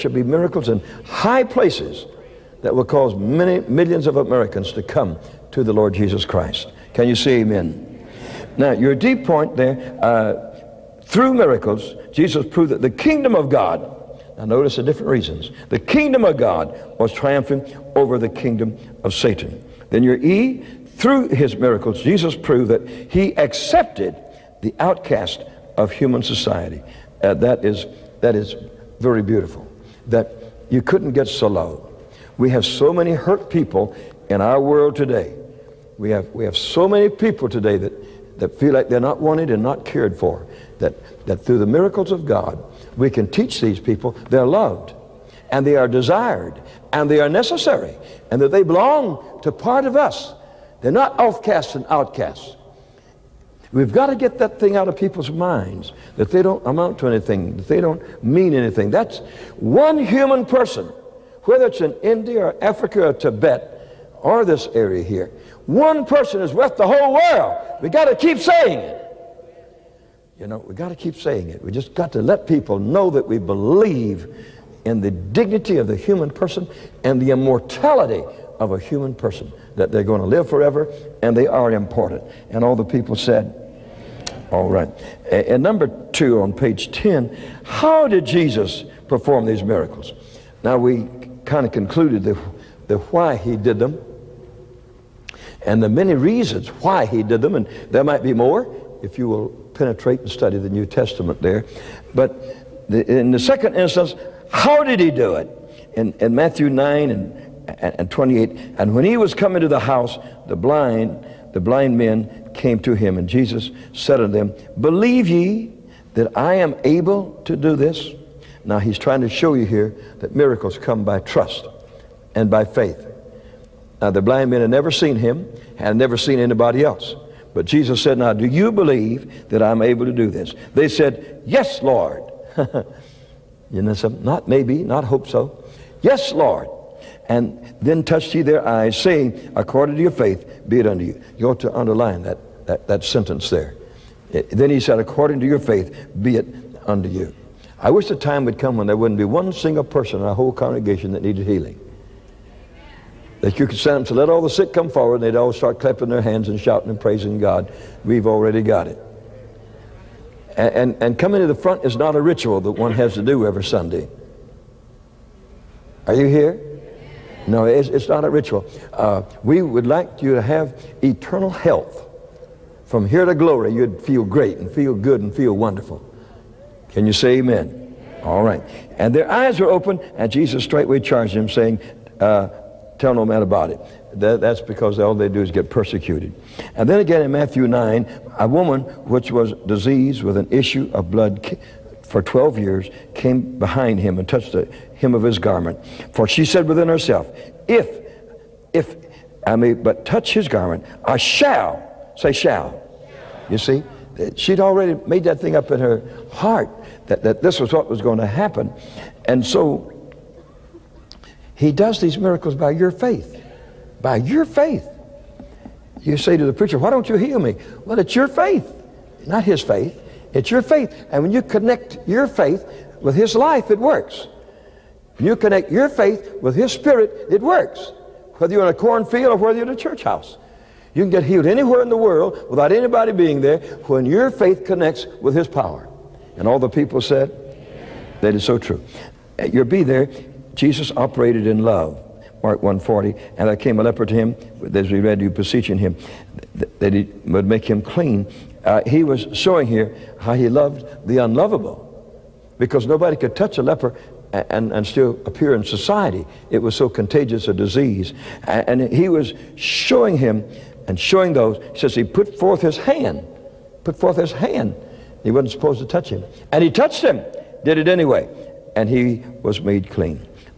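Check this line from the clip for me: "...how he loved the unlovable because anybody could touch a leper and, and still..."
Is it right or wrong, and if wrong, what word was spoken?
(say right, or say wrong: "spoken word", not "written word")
wrong: "nobody", not "anybody".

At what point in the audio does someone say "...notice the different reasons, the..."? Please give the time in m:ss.
0:14.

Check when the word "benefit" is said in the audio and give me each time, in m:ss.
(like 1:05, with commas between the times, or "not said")
not said.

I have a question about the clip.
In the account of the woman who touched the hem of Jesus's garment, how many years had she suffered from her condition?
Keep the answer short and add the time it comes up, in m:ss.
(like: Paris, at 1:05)
12, at 3:12.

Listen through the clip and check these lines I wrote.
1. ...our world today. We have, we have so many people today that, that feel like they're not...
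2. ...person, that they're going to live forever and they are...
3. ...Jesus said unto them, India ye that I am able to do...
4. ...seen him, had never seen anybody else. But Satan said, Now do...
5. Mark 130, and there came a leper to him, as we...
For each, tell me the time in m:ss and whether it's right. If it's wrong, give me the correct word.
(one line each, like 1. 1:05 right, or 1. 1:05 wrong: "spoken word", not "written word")
1. 0:34 right
2. 1:19 right
3. 1:53 wrong: "Believe", not "India"
4. 2:04 wrong: "Jesus", not "Satan"
5. 4:02 wrong: "140", not "130".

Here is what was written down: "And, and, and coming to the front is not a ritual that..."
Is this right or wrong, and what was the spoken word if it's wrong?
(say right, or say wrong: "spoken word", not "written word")
right.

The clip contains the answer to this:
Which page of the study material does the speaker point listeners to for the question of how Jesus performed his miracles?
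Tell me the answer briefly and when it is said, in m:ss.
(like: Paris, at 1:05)
page 10, at 1:26.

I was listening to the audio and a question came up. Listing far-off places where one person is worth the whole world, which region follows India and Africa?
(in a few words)
Tibet.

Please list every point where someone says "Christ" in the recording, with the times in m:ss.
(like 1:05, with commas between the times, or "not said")
0:06.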